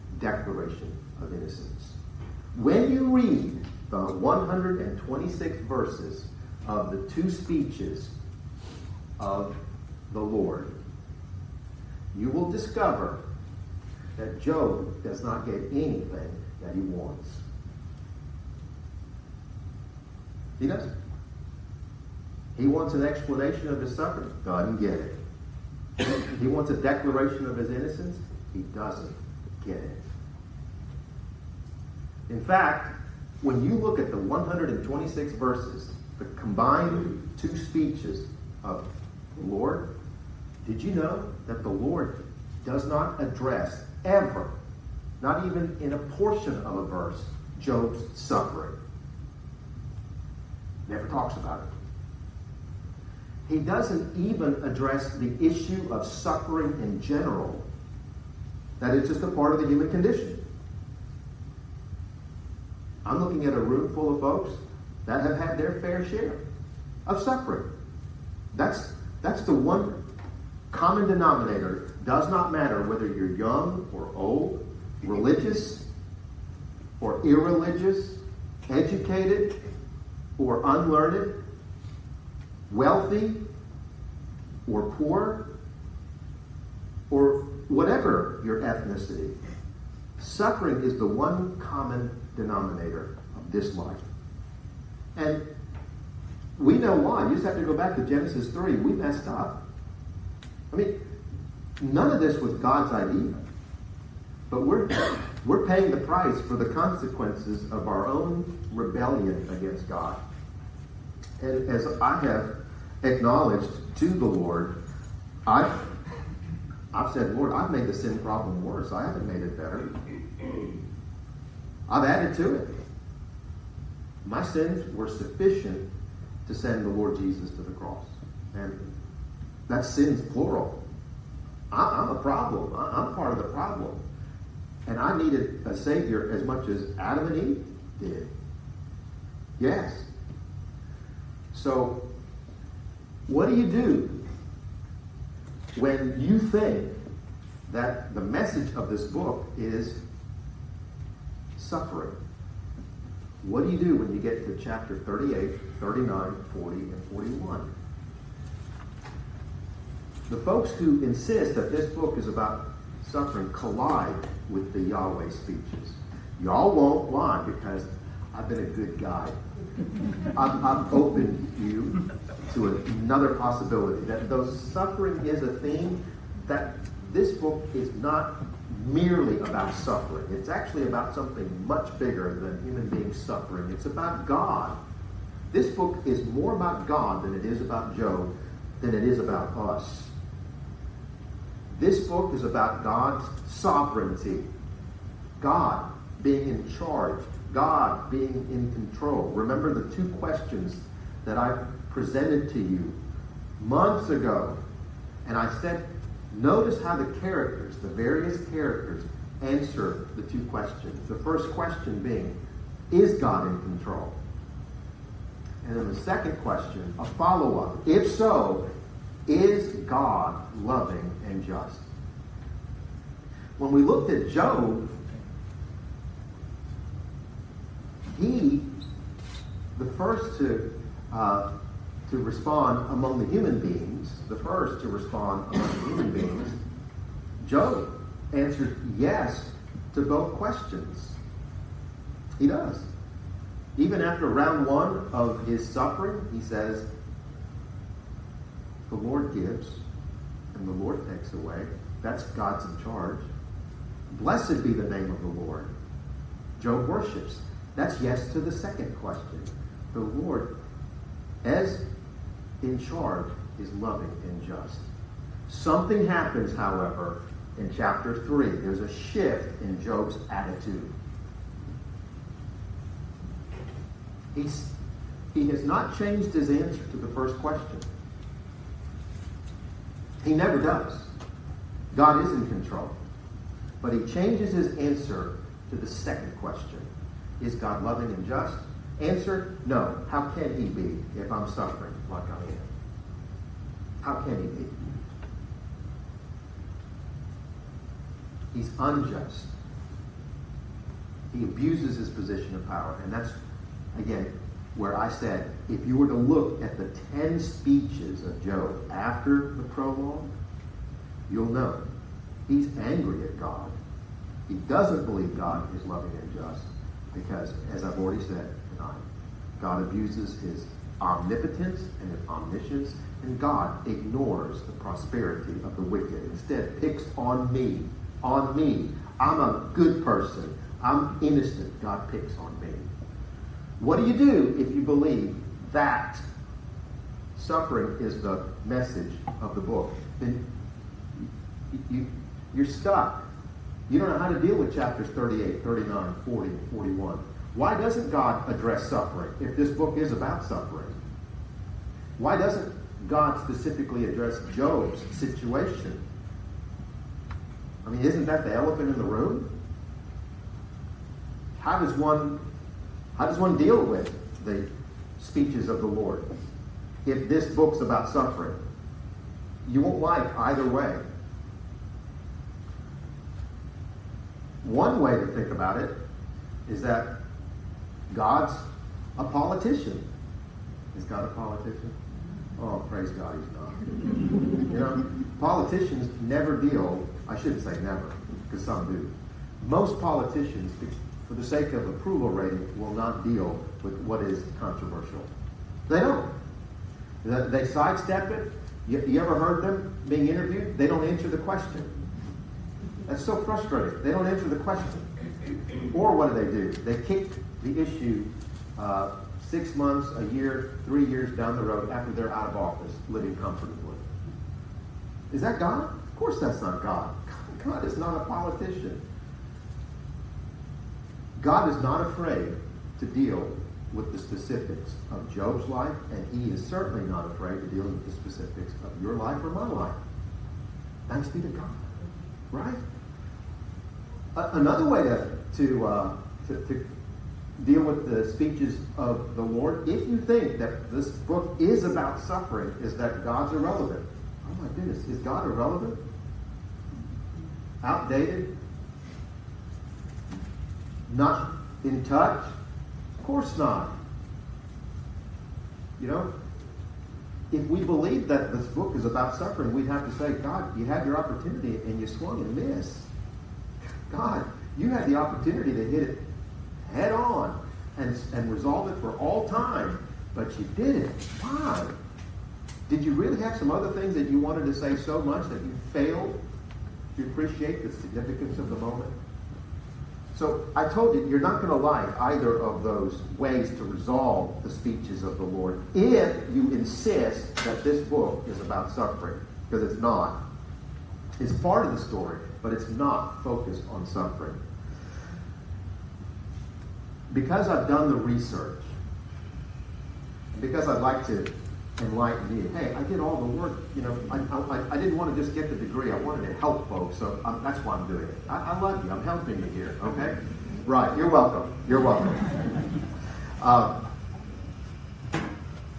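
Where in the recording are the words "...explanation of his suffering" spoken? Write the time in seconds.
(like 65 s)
23 s.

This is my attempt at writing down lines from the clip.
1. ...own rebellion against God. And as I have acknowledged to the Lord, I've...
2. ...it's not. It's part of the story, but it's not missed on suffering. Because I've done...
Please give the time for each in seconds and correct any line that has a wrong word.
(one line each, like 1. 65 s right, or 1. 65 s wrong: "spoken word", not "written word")
1. 108 s right
2. 489 s wrong: "focused", not "missed".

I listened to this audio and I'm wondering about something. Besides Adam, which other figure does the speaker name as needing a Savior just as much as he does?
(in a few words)
Eve.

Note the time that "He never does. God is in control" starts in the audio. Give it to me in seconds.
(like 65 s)
280 s.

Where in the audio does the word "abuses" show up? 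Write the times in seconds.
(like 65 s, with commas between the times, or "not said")
301 s, 319 s.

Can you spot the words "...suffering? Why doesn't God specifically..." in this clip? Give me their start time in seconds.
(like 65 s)
350 s.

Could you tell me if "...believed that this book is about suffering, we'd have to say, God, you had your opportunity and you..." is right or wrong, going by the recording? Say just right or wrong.
right.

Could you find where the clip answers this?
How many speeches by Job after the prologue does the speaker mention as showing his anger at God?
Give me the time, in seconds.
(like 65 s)
307 s.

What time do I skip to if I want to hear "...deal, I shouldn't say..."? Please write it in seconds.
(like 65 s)
386 s.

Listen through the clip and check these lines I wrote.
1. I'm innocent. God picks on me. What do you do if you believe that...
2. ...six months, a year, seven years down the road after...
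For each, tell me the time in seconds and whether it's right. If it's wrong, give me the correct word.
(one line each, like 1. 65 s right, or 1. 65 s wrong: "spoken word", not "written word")
1. 330 s right
2. 409 s wrong: "three", not "seven".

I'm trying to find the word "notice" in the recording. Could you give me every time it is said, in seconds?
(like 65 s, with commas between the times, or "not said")
206 s.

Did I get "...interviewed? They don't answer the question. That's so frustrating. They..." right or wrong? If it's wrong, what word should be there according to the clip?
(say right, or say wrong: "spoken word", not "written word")
right.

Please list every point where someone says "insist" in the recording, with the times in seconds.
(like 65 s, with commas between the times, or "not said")
161 s, 486 s.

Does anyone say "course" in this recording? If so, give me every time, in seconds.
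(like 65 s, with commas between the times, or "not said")
416 s, 453 s.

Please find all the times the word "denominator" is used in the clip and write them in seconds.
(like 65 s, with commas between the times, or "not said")
71 s, 92 s.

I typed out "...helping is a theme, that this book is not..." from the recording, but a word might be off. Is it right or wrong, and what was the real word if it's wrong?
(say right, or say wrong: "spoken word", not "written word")
wrong: "suffering", not "helping".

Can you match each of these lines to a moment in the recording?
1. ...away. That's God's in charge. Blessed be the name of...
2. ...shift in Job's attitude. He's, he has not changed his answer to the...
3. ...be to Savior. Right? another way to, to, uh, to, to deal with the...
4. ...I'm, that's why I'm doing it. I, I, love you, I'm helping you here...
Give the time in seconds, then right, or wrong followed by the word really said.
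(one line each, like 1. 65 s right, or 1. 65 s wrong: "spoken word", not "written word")
1. 251 s right
2. 268 s right
3. 431 s wrong: "God", not "Savior"
4. 507 s right.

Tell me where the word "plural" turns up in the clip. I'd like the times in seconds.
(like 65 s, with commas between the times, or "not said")
130 s.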